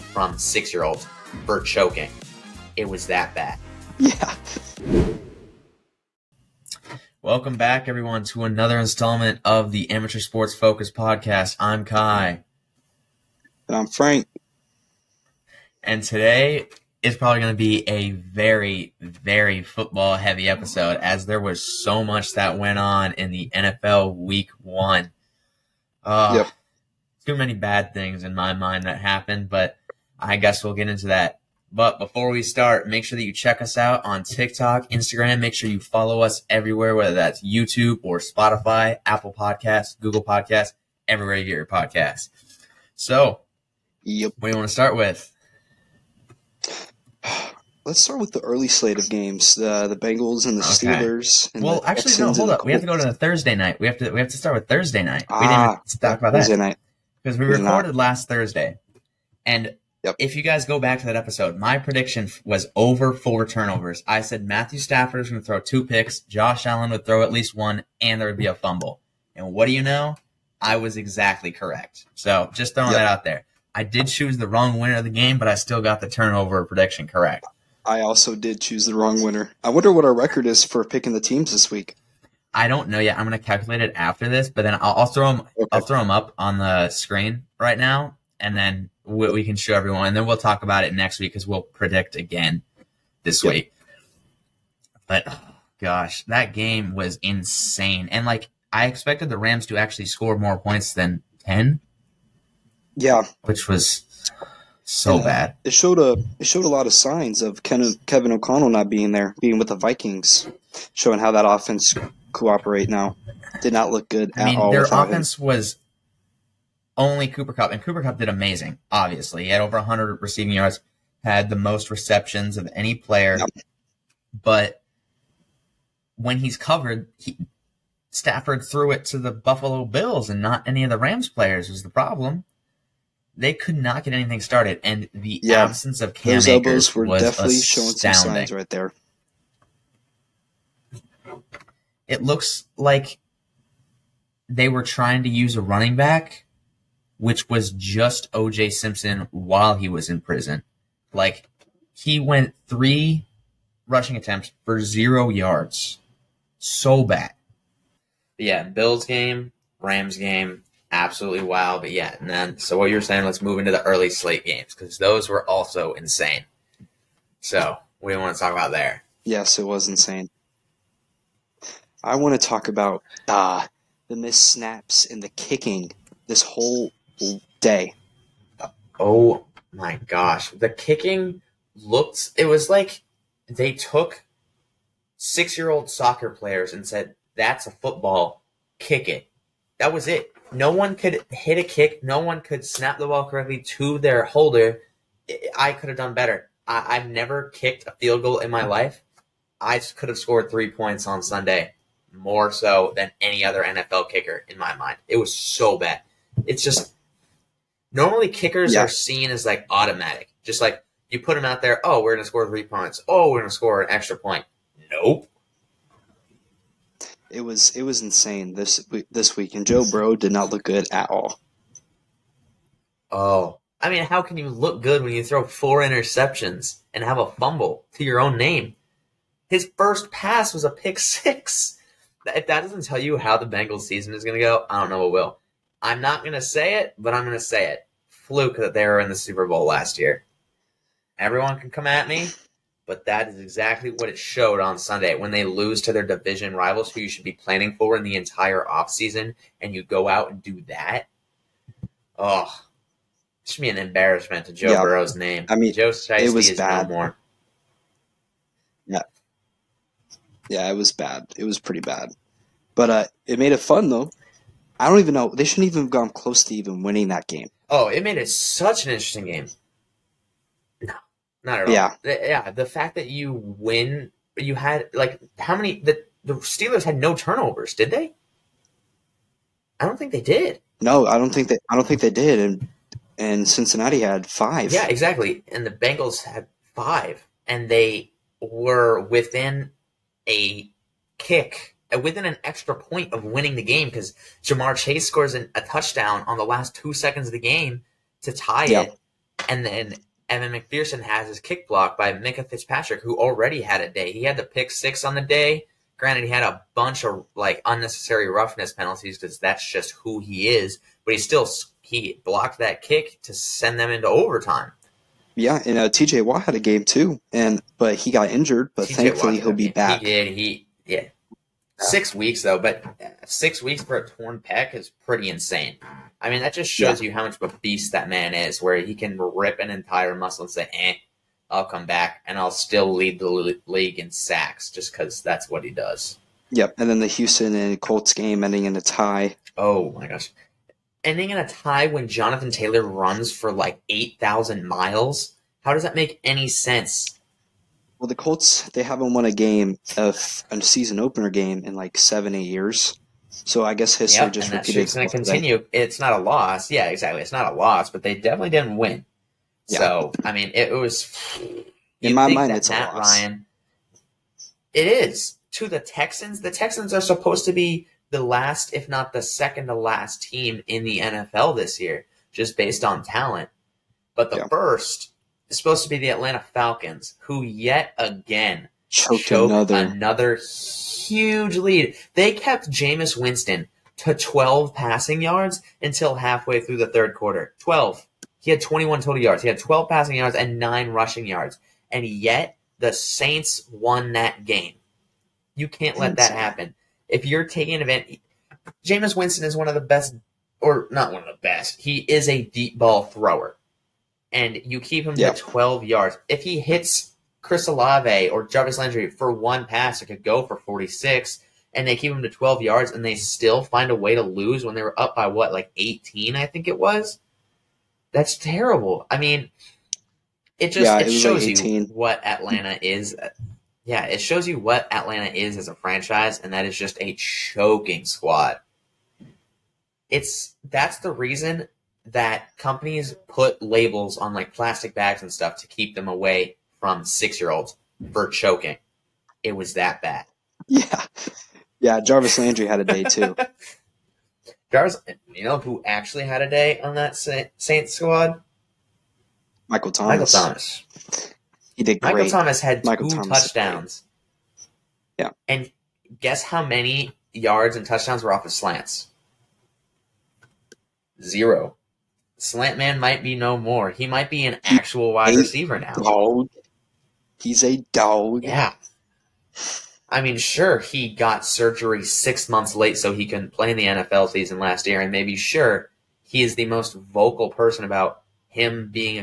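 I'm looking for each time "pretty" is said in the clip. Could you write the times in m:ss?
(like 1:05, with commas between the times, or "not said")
4:21, 5:25.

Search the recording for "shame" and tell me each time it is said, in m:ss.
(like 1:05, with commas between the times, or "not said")
not said.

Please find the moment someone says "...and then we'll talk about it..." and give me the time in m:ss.
1:30.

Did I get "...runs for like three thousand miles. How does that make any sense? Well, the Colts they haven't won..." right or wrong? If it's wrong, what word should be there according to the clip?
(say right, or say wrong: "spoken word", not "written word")
wrong: "eight", not "three".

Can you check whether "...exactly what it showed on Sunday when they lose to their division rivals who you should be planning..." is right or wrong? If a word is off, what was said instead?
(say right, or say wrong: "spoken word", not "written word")
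right.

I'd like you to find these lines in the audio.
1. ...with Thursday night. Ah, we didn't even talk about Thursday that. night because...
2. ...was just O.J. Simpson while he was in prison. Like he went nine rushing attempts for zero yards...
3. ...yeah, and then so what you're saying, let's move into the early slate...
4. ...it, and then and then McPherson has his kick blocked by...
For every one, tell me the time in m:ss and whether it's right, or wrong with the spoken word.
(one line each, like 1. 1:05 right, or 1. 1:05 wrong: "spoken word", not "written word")
1. 0:54 right
2. 2:27 wrong: "three", not "nine"
3. 2:41 right
4. 4:58 right.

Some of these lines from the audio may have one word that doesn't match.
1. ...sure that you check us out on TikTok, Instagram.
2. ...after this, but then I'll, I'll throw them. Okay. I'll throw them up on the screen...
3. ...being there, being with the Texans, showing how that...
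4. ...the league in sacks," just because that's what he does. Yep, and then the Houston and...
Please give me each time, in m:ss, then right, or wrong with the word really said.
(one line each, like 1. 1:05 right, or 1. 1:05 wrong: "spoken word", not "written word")
1. 0:33 right
2. 1:23 right
3. 1:48 wrong: "Vikings", not "Texans"
4. 5:33 right.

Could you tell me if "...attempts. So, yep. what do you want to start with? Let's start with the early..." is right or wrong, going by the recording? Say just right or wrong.
wrong.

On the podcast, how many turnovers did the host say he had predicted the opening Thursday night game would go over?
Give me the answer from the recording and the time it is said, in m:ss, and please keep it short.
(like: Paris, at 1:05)
4, at 1:03.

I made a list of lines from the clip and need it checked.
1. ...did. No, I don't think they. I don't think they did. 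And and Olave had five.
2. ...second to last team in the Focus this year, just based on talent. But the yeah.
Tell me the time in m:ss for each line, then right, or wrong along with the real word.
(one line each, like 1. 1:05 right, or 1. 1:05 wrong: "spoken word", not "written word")
1. 4:40 wrong: "Cincinnati", not "Olave"
2. 6:09 wrong: "NFL", not "Focus".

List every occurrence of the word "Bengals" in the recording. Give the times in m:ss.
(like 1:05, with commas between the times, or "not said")
0:49, 3:53, 4:45.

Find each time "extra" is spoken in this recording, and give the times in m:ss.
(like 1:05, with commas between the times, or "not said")
3:33, 4:52.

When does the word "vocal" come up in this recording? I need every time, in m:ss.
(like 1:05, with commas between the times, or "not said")
7:56.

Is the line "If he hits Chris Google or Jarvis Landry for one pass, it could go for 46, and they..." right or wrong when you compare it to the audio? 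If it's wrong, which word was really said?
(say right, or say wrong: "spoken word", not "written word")
wrong: "Olave", not "Google".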